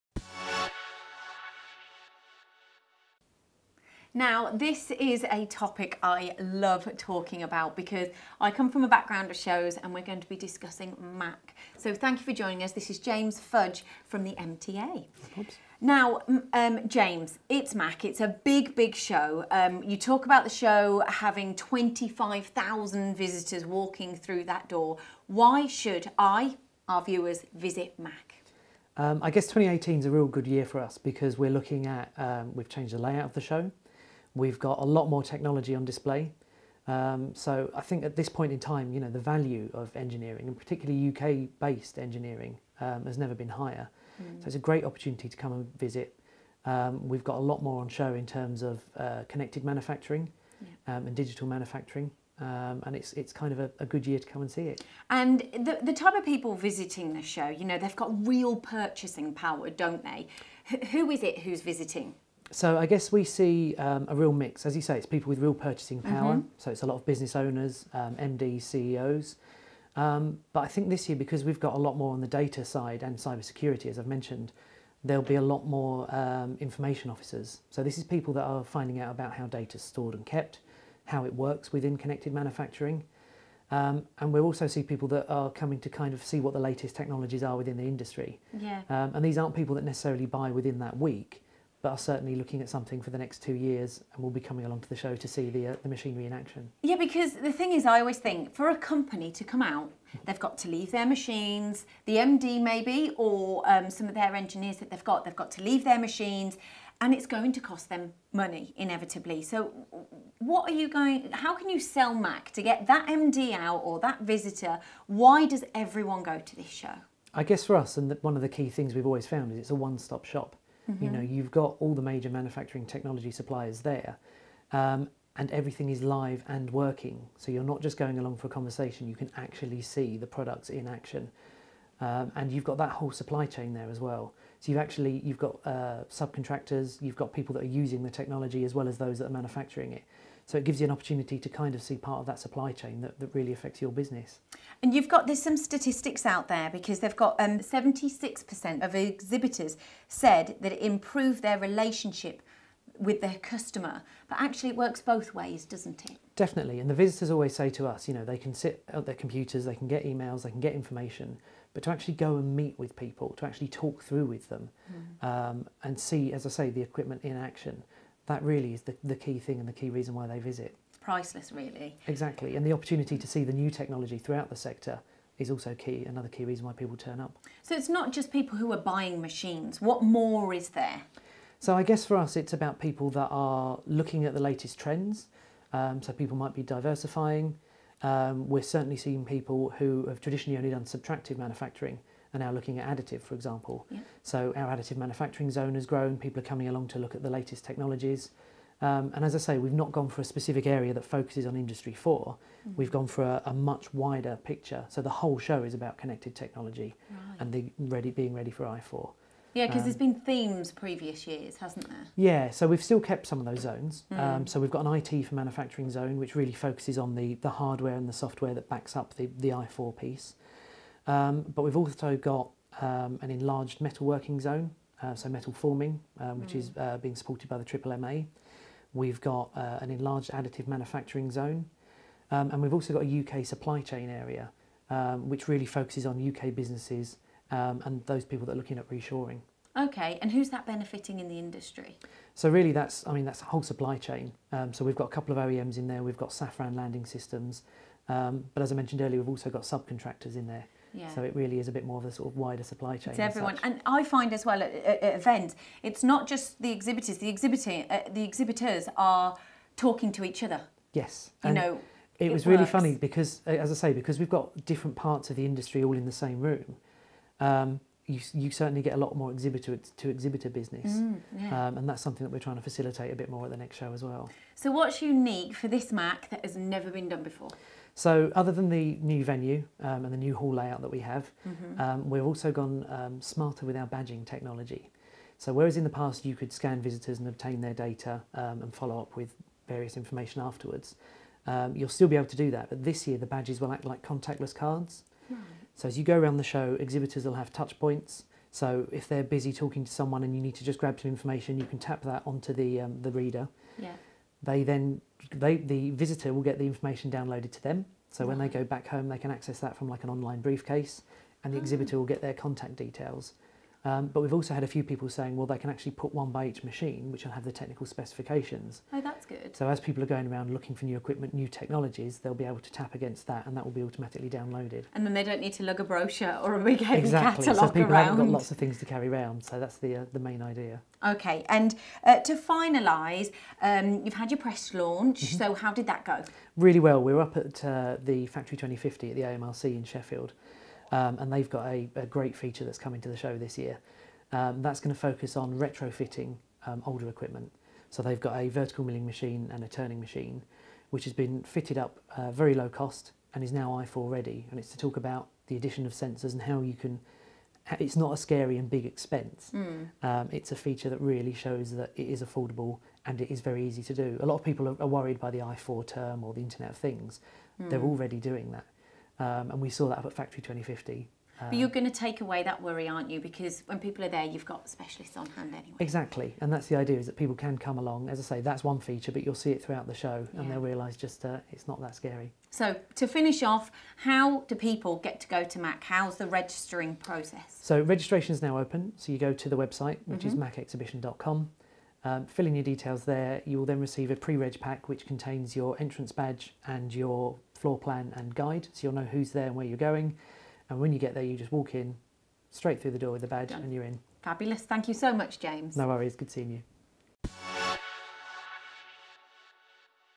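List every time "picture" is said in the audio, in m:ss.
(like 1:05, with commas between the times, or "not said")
3:24.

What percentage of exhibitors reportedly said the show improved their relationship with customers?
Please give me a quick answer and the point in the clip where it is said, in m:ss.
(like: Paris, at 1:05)
76%, at 2:27.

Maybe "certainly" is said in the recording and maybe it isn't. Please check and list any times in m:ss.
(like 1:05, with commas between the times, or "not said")
1:31, 3:08, 4:28.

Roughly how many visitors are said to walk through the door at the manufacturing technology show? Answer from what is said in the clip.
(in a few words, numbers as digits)
25,000.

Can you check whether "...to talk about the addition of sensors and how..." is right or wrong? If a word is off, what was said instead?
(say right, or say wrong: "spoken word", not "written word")
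right.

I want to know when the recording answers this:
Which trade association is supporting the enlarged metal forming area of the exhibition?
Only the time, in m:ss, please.
3:47.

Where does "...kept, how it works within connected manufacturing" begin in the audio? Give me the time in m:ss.
1:20.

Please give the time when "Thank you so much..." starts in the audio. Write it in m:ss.
6:44.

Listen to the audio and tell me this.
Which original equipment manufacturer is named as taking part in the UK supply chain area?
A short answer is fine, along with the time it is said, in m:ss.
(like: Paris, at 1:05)
Safran Landing Systems, at 4:06.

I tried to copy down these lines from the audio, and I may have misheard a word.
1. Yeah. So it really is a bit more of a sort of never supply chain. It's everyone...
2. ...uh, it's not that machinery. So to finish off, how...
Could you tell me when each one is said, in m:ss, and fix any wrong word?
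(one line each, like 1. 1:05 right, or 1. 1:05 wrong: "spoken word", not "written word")
1. 4:10 wrong: "wider", not "never"
2. 6:21 wrong: "scary", not "machinery".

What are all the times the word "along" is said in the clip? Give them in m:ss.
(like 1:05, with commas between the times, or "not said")
1:34, 2:08, 3:16, 6:17.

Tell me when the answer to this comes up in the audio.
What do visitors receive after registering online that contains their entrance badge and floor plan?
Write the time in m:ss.
6:34.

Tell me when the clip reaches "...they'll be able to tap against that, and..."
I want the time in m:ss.
5:22.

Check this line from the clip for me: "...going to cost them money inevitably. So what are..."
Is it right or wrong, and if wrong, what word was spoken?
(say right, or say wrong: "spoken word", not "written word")
right.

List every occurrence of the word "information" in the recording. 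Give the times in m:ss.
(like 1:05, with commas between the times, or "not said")
1:16, 2:40, 4:49, 5:01, 5:06.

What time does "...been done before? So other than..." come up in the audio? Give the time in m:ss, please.
4:36.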